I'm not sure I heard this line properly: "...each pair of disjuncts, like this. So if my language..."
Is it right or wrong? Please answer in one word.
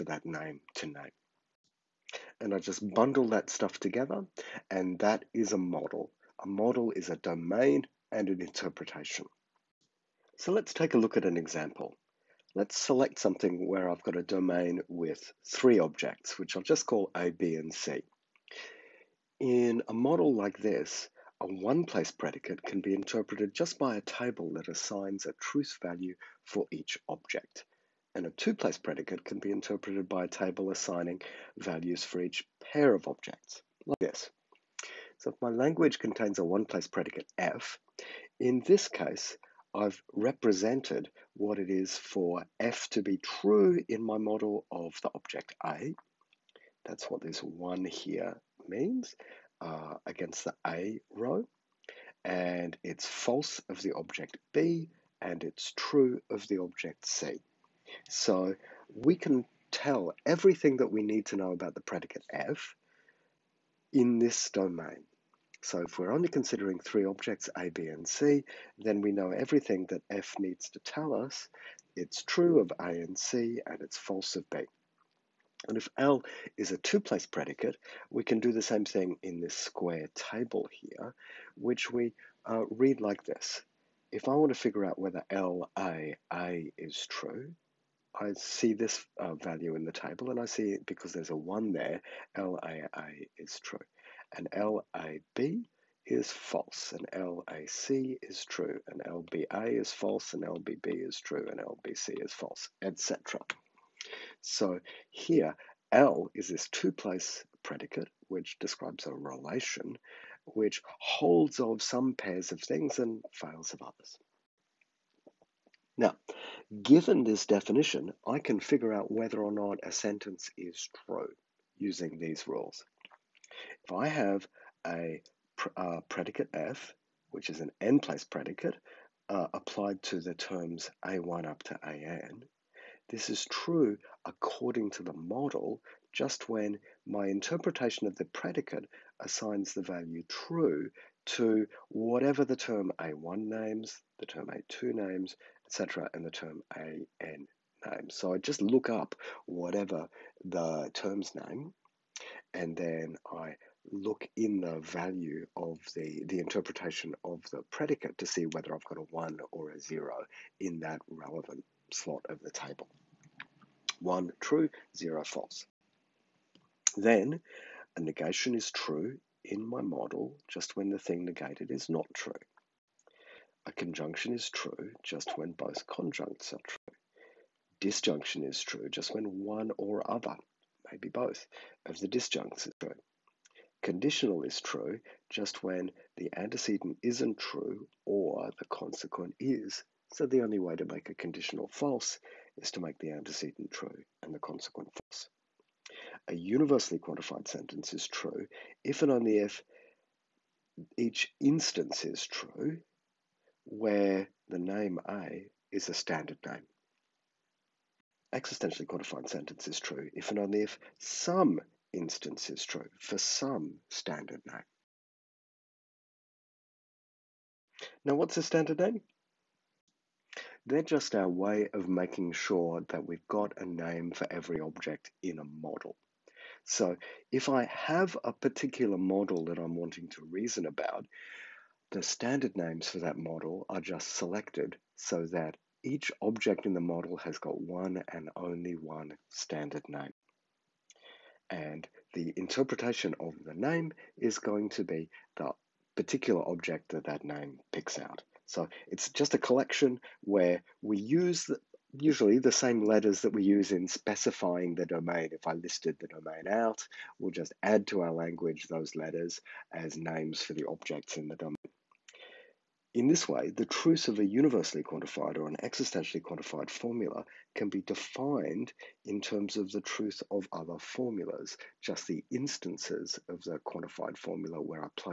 wrong.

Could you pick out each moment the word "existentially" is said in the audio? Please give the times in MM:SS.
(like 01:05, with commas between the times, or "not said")
03:28, 04:25.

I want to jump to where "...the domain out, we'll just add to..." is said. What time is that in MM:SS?
04:15.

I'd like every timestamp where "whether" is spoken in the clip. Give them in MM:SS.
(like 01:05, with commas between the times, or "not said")
01:24, 01:59, 02:38.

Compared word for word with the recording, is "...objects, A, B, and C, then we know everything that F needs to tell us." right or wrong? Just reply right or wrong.
right.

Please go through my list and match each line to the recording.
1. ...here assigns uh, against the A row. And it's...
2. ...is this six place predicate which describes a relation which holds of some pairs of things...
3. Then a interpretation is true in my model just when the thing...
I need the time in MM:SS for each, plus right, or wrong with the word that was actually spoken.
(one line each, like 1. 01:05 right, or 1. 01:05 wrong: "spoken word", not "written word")
1. 00:47 wrong: "means", not "assigns"
2. 01:46 wrong: "two", not "six"
3. 02:46 wrong: "negation", not "interpretation".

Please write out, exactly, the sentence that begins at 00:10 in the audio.
So let's take a look at an example.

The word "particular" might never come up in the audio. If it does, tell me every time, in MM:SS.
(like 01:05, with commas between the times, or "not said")
03:48, 04:05.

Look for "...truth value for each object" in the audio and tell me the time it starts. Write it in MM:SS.
00:25.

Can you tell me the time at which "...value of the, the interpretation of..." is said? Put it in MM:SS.
02:34.